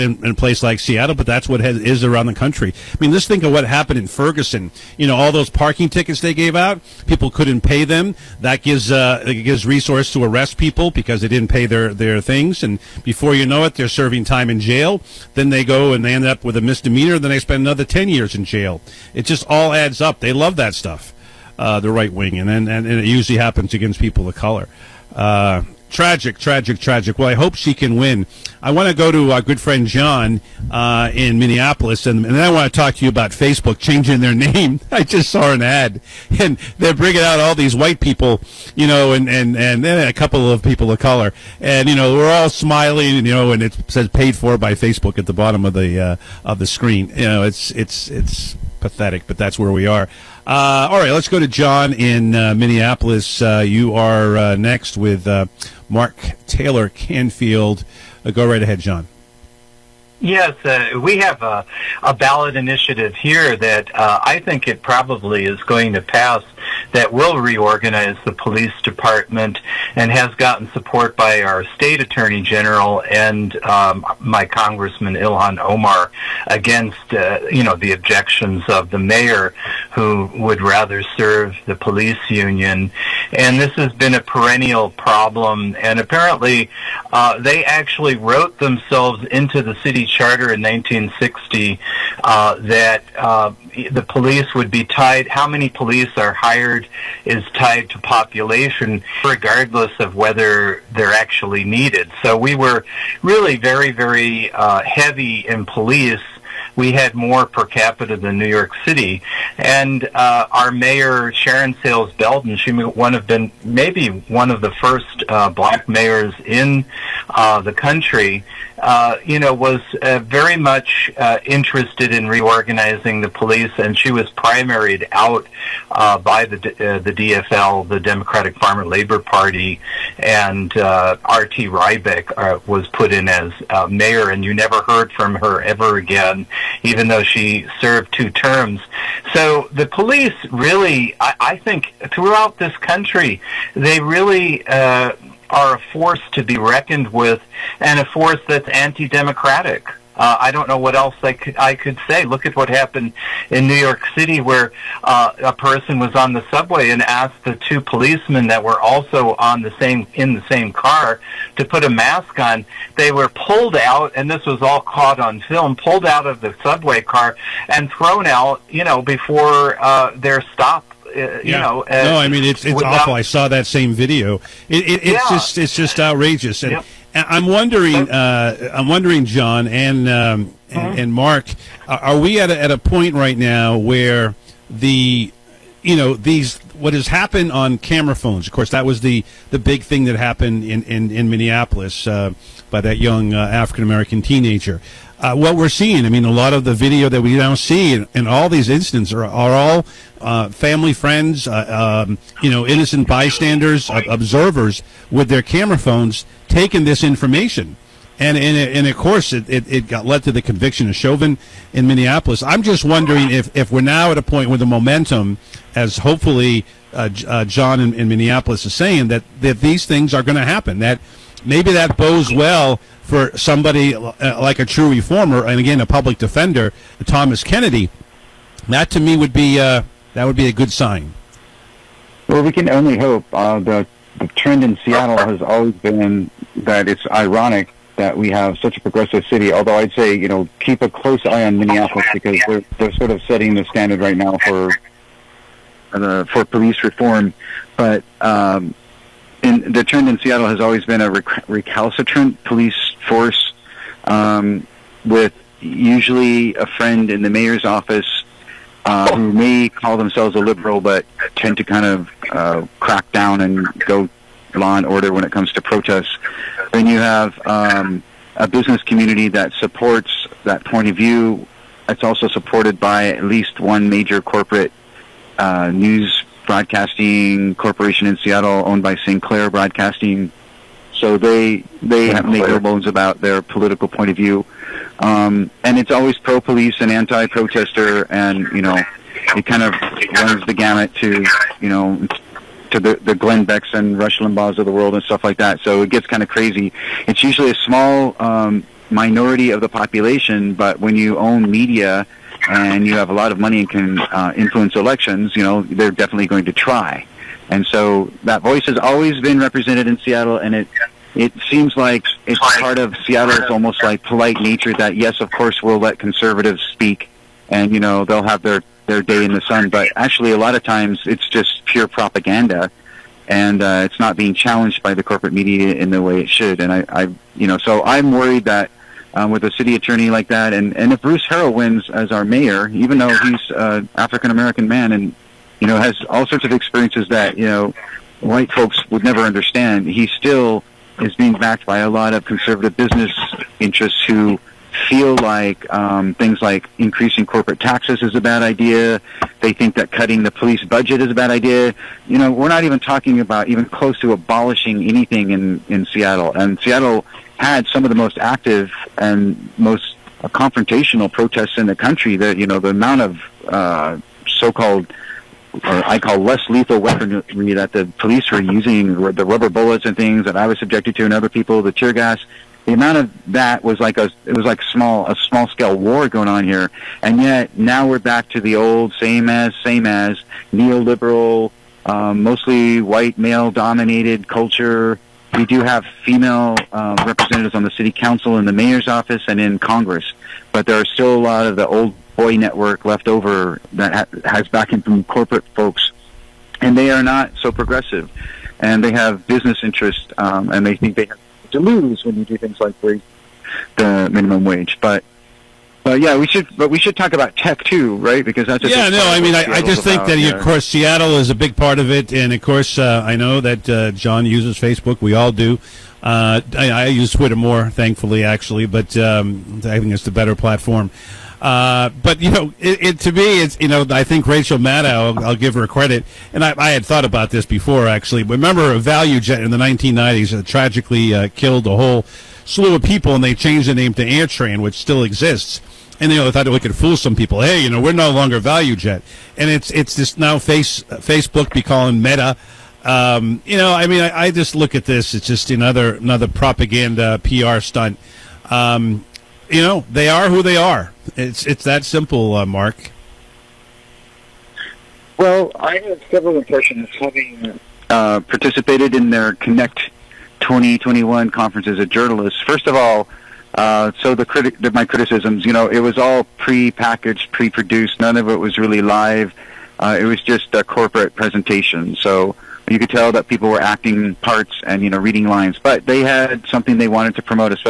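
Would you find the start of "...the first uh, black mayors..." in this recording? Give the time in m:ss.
1:54.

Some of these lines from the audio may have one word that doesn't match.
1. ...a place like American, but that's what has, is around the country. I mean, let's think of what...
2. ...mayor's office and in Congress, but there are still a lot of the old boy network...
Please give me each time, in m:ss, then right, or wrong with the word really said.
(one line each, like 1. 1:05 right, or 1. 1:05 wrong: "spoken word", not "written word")
1. 0:00 wrong: "Seattle", not "American"
2. 6:28 right.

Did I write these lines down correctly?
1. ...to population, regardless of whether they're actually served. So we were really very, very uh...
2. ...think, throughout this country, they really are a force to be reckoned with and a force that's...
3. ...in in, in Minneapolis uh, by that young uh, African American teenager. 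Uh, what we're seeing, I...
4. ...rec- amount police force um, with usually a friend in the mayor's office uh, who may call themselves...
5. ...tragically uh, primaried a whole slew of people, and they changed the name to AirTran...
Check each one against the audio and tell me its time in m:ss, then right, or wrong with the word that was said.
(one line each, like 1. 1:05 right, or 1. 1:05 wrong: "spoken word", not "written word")
1. 1:37 wrong: "needed", not "served"
2. 2:21 right
3. 3:10 right
4. 4:11 wrong: "recalcitrant", not "amount"
5. 7:10 wrong: "killed", not "primaried".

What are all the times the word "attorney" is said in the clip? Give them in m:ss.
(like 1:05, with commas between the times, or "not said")
1:12, 5:29.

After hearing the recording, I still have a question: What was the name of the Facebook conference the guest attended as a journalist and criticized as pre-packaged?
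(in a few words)
Connect 2021.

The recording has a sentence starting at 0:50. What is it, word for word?
Uh, all right, let's go to John in uh, Minneapolis.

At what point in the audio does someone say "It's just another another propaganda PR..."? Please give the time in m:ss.
7:25.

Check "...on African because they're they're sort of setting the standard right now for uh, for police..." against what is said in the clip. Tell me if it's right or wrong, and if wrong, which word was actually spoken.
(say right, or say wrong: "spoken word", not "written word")
wrong: "Minneapolis", not "African".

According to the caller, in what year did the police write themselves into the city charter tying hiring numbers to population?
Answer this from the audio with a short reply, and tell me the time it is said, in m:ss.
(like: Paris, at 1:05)
1960, at 1:30.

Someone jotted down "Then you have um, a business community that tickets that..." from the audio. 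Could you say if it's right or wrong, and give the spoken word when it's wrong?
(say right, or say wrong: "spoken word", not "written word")
wrong: "supports", not "tickets".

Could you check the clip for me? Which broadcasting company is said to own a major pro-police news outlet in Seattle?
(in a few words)
Sinclair Broadcasting.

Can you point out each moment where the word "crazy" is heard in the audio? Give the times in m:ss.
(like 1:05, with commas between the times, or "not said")
4:56.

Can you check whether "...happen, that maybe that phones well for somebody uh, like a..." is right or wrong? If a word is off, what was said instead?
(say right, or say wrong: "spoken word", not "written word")
wrong: "bodes", not "phones".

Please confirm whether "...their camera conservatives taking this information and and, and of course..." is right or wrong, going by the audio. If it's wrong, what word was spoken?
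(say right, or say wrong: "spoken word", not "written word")
wrong: "phones", not "conservatives".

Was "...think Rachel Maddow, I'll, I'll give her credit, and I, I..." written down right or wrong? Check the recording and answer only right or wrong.
right.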